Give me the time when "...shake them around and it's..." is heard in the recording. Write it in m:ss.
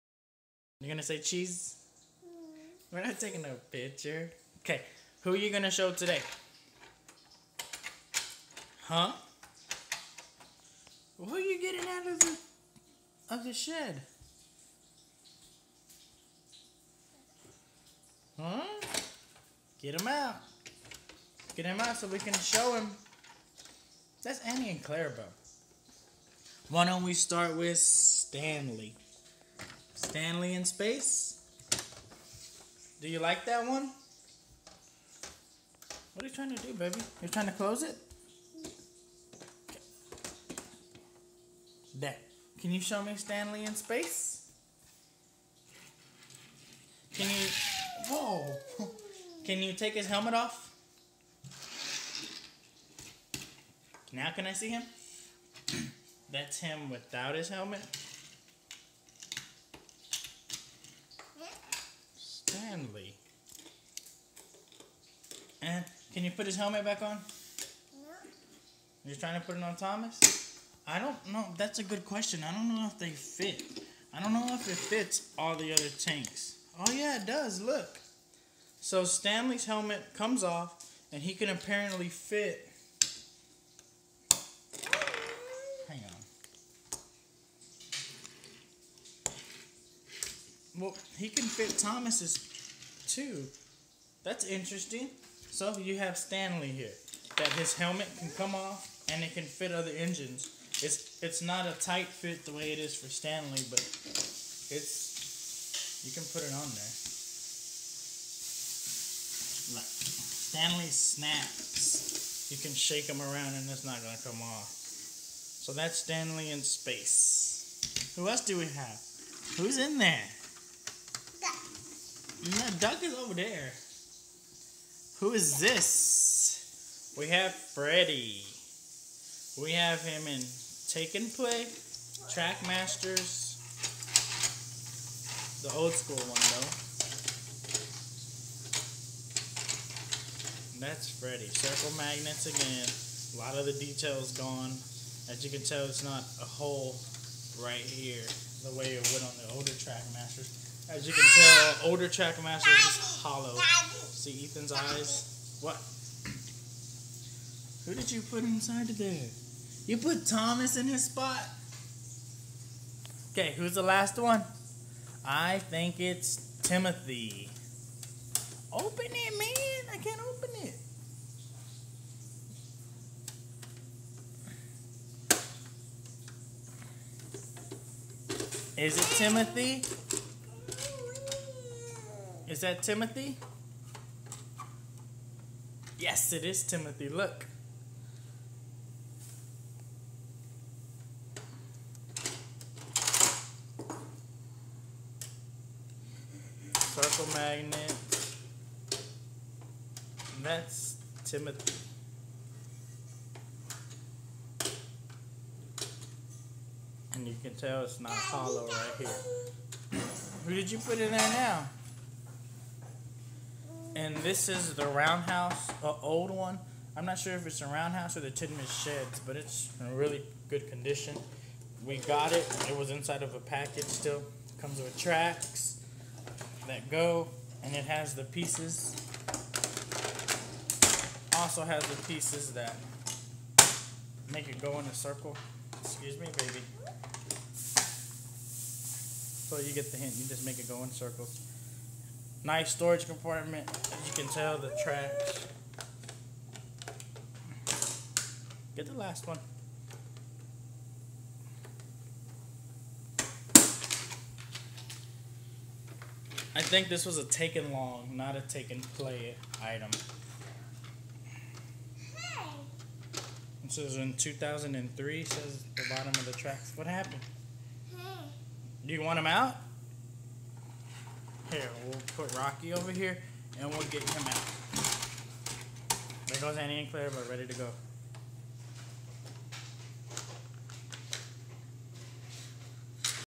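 1:52.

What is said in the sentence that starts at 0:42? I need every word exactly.
Can you show me Stanley in Space?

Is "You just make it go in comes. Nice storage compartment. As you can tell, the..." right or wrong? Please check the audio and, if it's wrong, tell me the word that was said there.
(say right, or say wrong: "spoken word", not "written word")
wrong: "circles", not "comes".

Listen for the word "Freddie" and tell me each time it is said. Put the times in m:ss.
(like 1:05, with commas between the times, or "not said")
2:07, 2:21.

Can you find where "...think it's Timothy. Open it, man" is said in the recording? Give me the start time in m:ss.
2:45.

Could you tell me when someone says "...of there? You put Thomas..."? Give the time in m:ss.
2:38.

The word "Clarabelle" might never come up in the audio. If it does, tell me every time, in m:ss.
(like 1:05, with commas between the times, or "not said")
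0:24, 4:36.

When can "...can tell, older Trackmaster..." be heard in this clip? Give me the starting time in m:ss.
2:31.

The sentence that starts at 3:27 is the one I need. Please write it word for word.
And you can tell it's not hollow right here.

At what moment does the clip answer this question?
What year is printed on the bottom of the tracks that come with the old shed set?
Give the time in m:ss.
4:24.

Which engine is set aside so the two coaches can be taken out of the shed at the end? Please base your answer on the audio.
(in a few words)
Rocky.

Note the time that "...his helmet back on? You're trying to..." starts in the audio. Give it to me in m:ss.
1:06.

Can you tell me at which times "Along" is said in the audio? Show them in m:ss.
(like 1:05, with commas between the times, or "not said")
4:17.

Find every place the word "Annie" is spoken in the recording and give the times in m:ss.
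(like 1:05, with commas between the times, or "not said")
0:24, 4:36.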